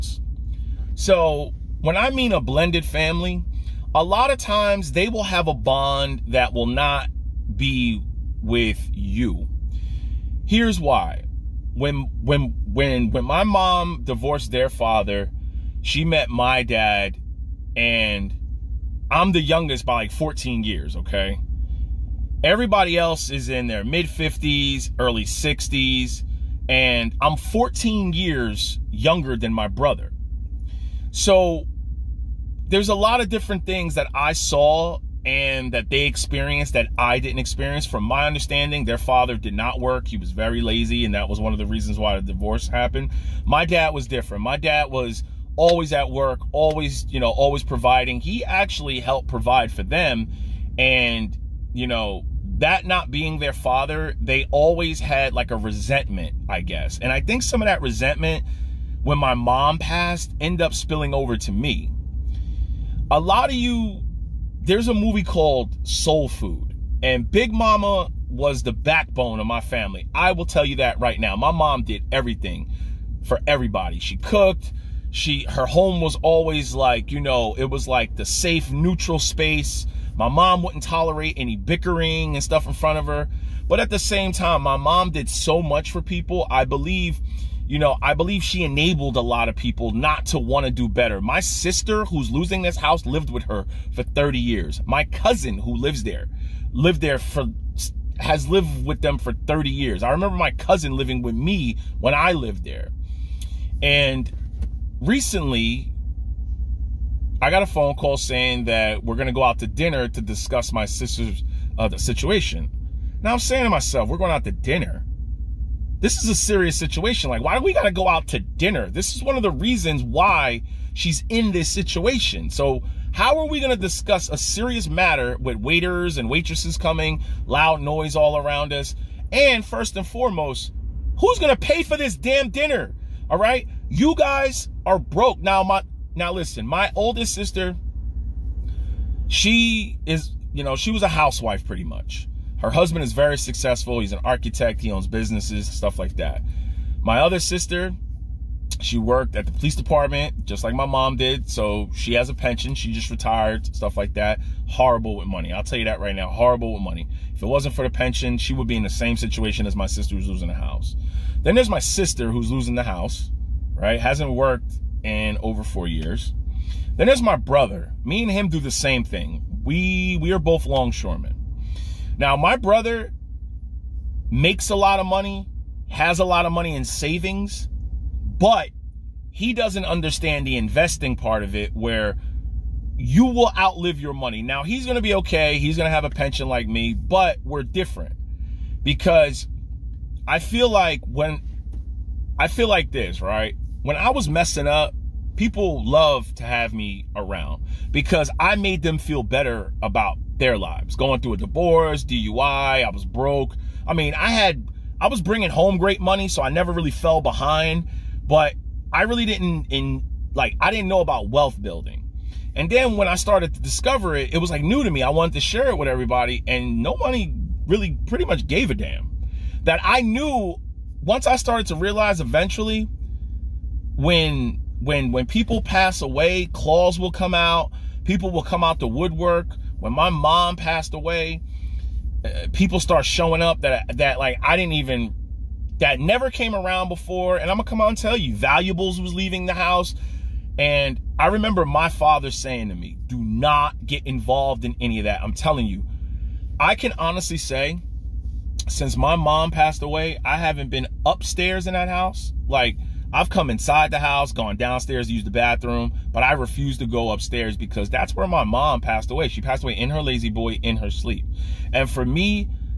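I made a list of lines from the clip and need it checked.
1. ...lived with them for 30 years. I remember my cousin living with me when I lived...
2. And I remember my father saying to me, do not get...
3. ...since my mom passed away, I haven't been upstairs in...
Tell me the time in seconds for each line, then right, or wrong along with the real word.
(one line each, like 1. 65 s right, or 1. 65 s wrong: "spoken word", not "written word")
1. 98 s right
2. 240 s right
3. 248 s right.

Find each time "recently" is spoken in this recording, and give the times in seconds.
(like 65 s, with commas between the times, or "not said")
104 s.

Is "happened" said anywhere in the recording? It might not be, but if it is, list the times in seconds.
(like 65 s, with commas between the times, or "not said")
42 s.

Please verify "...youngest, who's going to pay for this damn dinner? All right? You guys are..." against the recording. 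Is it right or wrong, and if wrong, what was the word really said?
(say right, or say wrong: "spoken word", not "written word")
wrong: "foremost", not "youngest".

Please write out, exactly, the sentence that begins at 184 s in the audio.
Now, he's going to be okay.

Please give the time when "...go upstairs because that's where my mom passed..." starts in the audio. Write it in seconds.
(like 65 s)
256 s.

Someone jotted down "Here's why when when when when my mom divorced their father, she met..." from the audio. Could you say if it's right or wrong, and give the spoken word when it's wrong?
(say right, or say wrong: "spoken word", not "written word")
right.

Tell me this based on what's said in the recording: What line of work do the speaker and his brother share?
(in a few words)
Longshoremen.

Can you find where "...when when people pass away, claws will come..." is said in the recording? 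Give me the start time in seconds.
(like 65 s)
224 s.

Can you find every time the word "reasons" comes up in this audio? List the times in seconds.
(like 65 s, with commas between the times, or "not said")
41 s, 119 s.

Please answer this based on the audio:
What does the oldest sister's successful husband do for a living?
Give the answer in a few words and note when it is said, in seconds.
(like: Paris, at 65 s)
Architect, at 144 s.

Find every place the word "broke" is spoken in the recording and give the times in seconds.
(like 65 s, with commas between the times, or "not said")
134 s, 203 s.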